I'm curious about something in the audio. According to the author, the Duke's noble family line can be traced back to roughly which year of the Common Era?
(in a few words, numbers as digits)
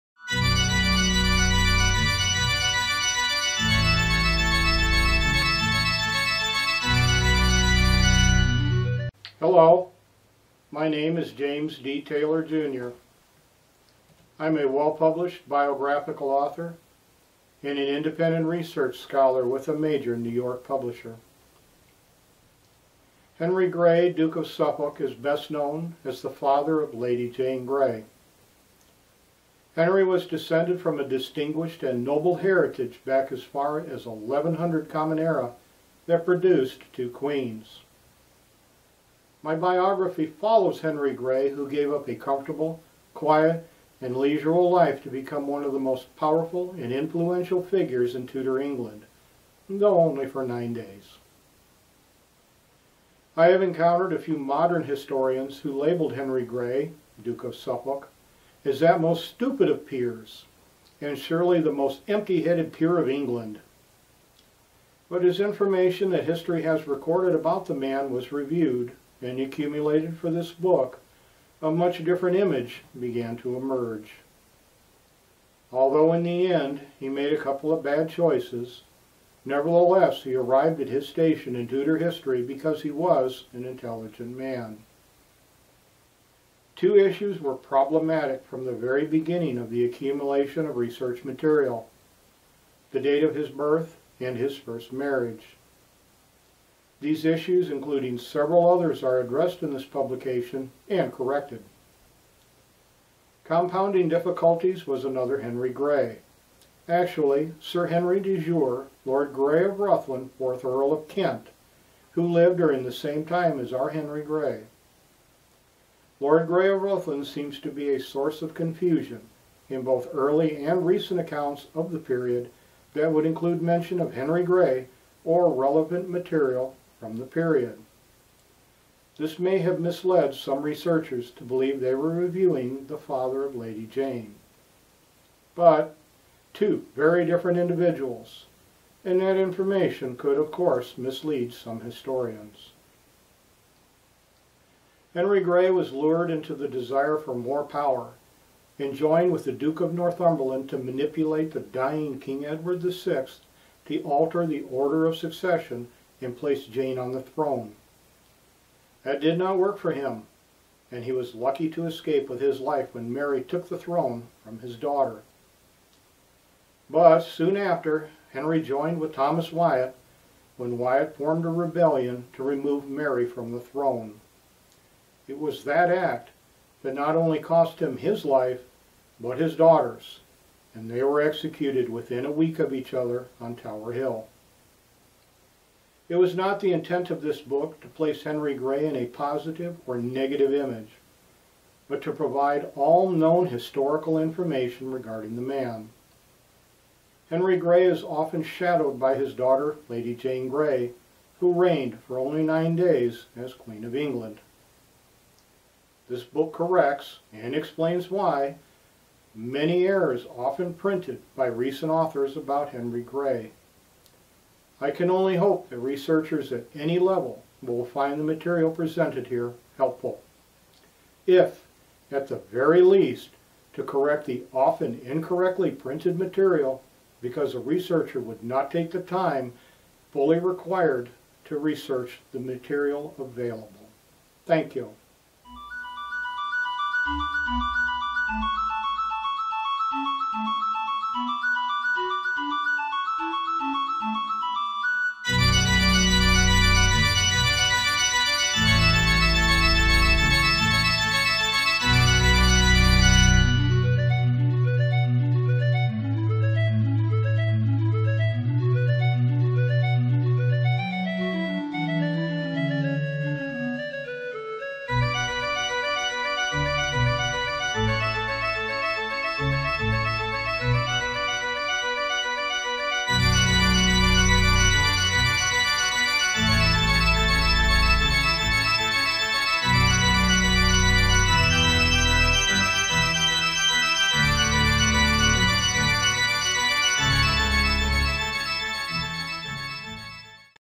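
1100.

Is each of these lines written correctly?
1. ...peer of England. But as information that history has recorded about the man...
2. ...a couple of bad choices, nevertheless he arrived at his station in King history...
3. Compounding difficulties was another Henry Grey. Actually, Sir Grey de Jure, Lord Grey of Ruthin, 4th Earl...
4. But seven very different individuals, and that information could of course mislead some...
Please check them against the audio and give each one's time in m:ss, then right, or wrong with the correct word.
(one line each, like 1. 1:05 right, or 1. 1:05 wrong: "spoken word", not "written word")
1. 1:02 right
2. 1:17 wrong: "Tudor", not "King"
3. 1:43 wrong: "Henry", not "Grey"
4. 2:15 wrong: "two", not "seven".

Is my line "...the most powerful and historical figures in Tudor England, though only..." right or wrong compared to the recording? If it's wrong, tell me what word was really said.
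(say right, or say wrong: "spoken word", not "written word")
wrong: "influential", not "historical".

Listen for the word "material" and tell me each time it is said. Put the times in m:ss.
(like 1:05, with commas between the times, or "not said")
1:31, 2:06, 3:38, 3:46, 3:52.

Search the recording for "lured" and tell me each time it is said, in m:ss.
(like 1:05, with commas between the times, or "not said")
2:25.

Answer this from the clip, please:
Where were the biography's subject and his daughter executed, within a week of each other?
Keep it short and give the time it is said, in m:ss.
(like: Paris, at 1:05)
Tower Hill, at 3:03.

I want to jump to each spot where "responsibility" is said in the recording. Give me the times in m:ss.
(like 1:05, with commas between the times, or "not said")
not said.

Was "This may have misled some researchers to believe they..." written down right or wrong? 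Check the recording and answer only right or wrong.
right.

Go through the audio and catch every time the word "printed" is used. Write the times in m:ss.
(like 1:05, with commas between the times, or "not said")
3:30, 3:45.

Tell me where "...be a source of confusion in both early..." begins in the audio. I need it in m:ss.
1:57.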